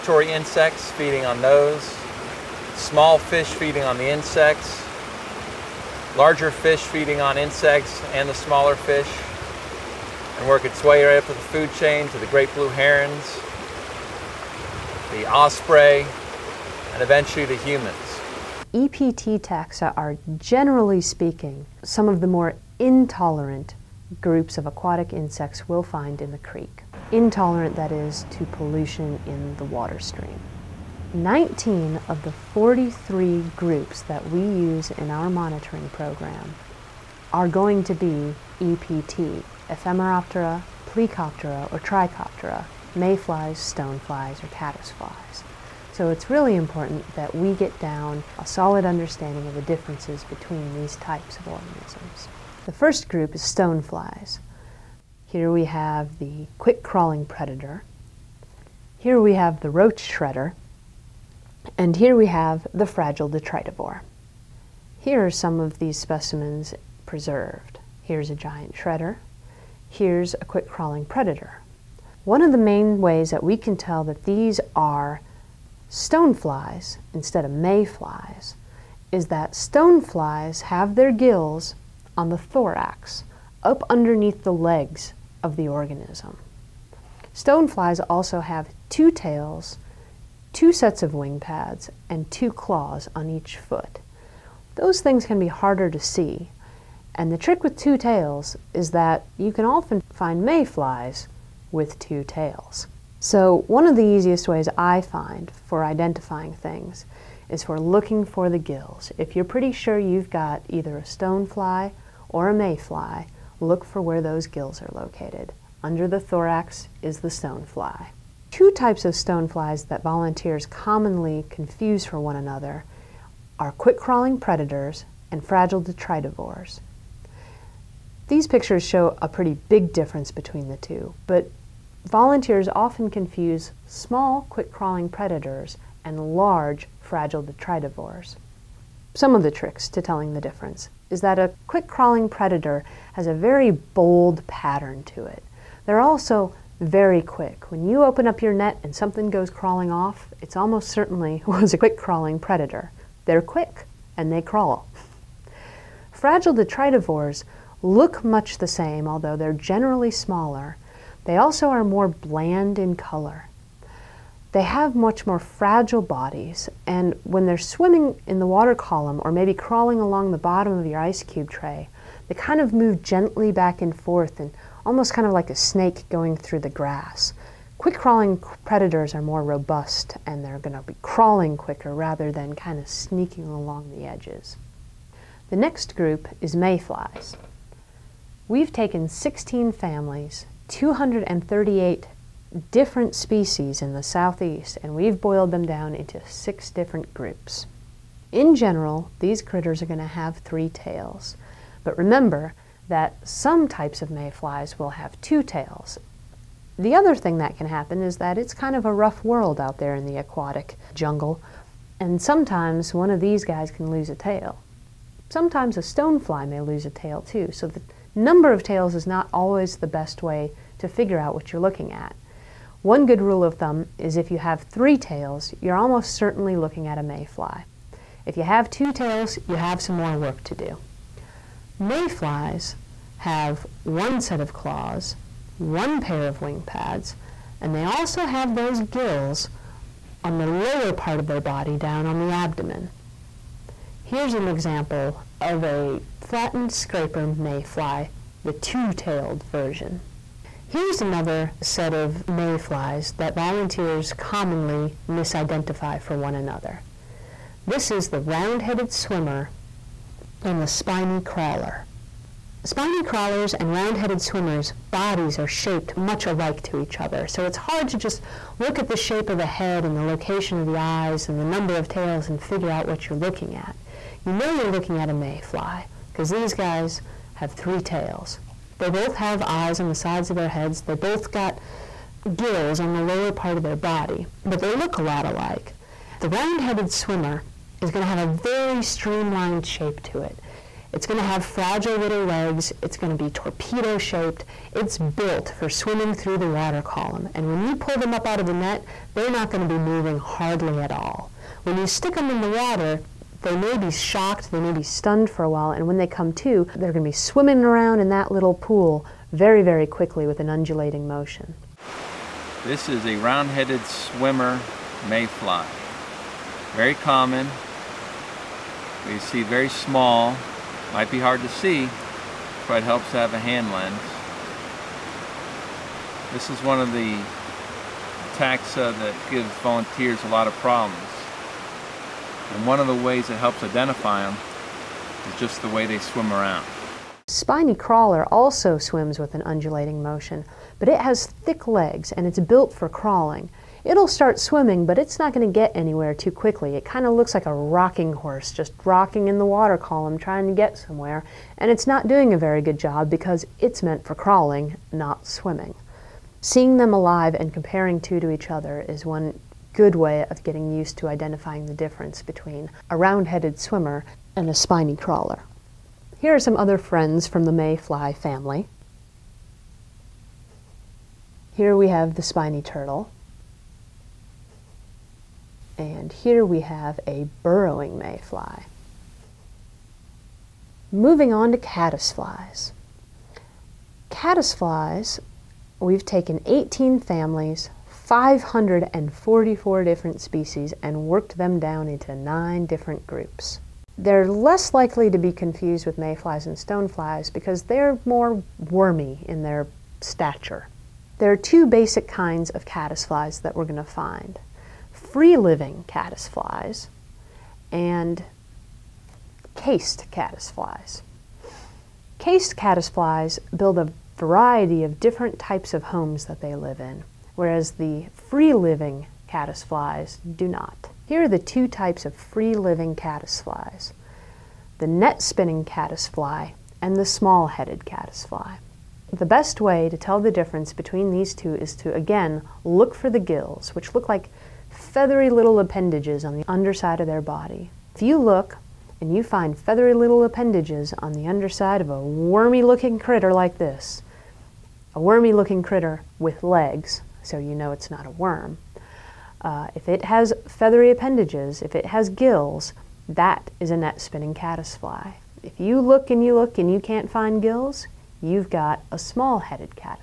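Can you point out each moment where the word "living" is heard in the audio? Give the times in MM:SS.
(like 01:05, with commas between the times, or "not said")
06:44, 06:58, 07:02.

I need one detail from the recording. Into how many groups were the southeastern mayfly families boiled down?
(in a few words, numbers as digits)
6.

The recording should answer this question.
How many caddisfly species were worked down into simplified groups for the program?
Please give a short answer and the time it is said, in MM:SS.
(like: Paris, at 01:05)
544, at 06:28.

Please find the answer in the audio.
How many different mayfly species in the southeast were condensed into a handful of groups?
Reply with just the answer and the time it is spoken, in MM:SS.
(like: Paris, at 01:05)
238, at 03:10.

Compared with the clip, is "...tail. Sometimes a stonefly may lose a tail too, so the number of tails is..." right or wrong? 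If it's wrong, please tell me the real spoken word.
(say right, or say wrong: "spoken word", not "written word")
right.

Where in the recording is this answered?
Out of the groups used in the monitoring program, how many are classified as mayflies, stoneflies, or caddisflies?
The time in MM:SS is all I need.
00:31.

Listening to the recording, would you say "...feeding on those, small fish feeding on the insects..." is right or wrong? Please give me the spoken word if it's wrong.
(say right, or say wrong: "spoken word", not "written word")
right.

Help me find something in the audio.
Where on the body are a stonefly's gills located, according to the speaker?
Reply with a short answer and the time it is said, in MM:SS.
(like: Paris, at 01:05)
On the thorax, at 01:22.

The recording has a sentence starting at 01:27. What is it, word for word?
Stoneflies also have two tails, two sets of wing pads, and two claws on each foot.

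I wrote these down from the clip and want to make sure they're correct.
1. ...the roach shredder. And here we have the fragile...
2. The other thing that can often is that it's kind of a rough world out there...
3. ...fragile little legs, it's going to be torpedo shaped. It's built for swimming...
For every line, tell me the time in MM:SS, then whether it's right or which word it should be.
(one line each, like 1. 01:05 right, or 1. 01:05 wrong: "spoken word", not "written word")
1. 00:59 right
2. 03:26 wrong: "happen", not "often"
3. 04:51 right.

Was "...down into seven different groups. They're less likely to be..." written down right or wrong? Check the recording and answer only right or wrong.
wrong.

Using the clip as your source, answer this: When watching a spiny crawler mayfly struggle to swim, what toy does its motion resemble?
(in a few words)
A rocking horse.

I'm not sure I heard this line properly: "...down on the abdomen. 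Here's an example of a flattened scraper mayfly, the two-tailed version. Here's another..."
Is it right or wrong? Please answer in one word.
right.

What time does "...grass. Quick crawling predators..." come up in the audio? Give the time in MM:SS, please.
02:56.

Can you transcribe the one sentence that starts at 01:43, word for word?
So one of the easiest ways I find for identifying things is for looking for the gills.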